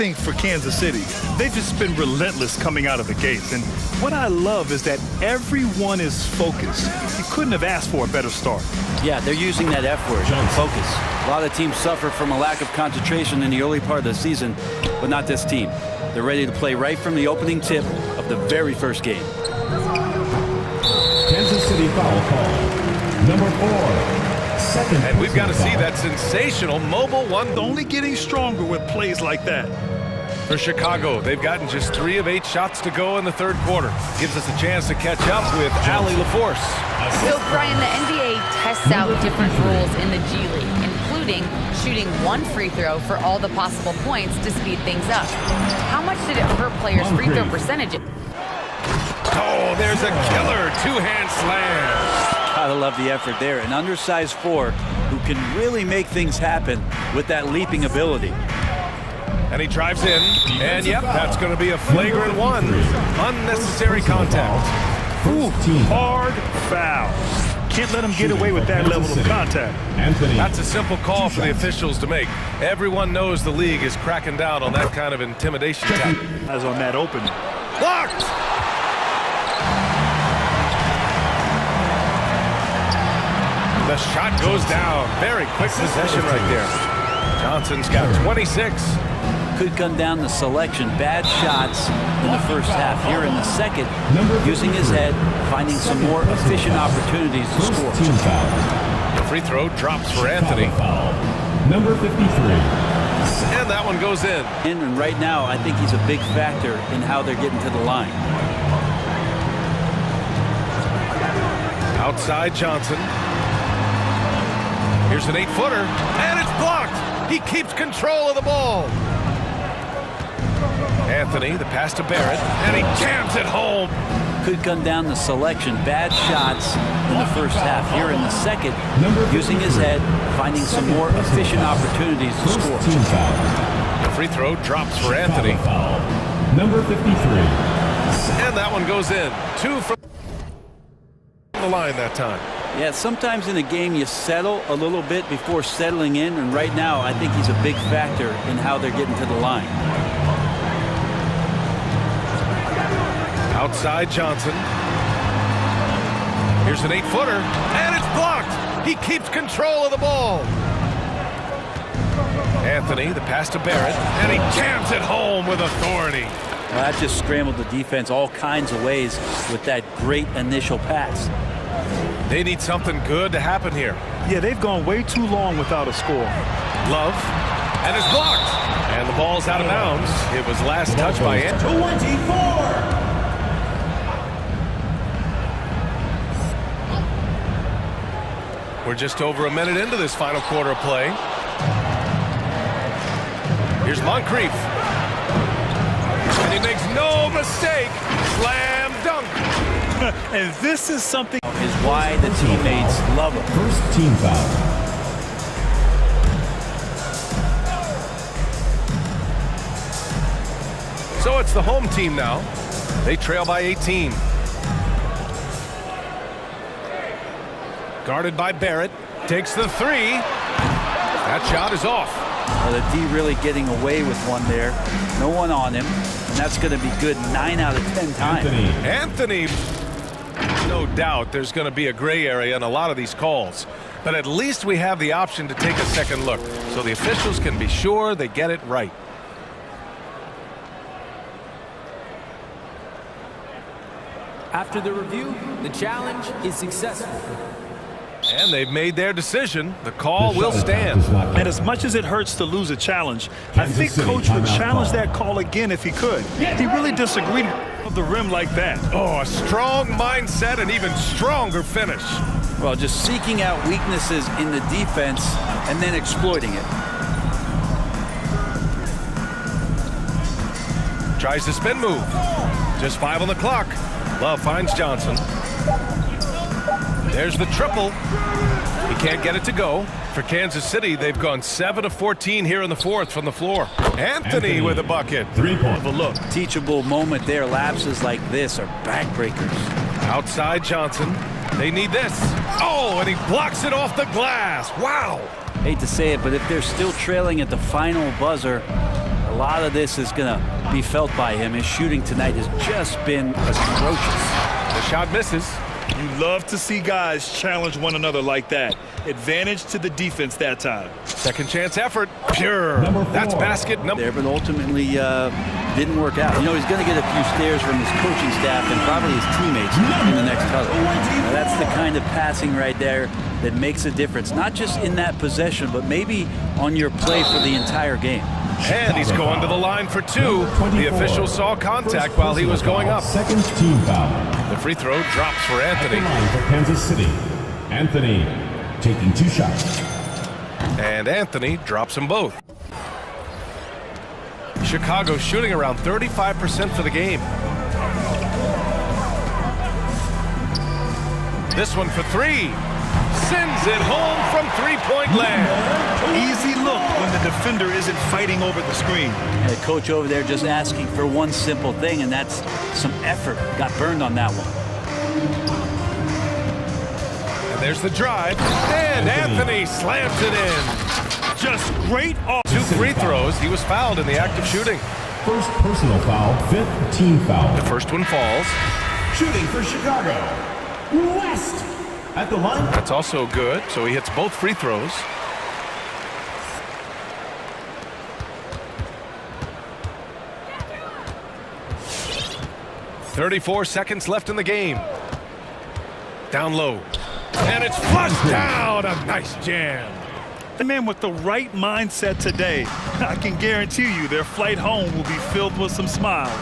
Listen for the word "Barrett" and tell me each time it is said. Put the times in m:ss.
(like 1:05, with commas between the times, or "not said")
2:02, 2:43, 3:38.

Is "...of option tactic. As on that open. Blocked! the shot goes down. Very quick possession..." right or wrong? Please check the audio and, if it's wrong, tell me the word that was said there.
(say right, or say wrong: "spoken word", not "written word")
wrong: "intimidation", not "option".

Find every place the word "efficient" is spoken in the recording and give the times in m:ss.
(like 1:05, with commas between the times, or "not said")
1:36, 2:11.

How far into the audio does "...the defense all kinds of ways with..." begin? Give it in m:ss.
2:47.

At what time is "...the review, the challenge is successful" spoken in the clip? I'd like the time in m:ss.
4:04.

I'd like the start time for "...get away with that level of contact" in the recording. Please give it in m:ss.
1:08.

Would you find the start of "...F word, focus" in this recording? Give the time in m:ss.
0:09.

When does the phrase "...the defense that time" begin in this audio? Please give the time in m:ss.
5:09.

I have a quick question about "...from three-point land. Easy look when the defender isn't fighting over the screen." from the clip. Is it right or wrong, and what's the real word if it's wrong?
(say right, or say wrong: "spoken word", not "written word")
right.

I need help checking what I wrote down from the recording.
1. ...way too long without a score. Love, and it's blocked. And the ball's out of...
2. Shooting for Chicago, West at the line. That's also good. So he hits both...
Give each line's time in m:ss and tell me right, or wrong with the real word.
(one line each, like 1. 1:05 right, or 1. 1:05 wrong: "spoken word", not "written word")
1. 2:54 right
2. 6:19 right.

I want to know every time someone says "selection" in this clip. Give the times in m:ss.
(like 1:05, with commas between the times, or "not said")
1:30, 2:05.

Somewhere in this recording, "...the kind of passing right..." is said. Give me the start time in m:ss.
5:21.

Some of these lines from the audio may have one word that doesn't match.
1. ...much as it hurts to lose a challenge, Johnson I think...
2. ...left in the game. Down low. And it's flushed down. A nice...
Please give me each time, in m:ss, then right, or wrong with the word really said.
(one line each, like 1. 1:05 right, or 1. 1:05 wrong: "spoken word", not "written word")
1. 4:11 wrong: "Kansas", not "Johnson"
2. 6:34 right.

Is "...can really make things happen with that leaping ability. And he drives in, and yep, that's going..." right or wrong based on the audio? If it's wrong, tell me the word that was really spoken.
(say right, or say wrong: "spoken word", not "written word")
right.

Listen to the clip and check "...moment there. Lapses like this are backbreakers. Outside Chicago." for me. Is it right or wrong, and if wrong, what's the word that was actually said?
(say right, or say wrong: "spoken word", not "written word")
wrong: "Johnson", not "Chicago".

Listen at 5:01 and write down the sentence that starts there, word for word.
His shooting tonight has just been atrocious.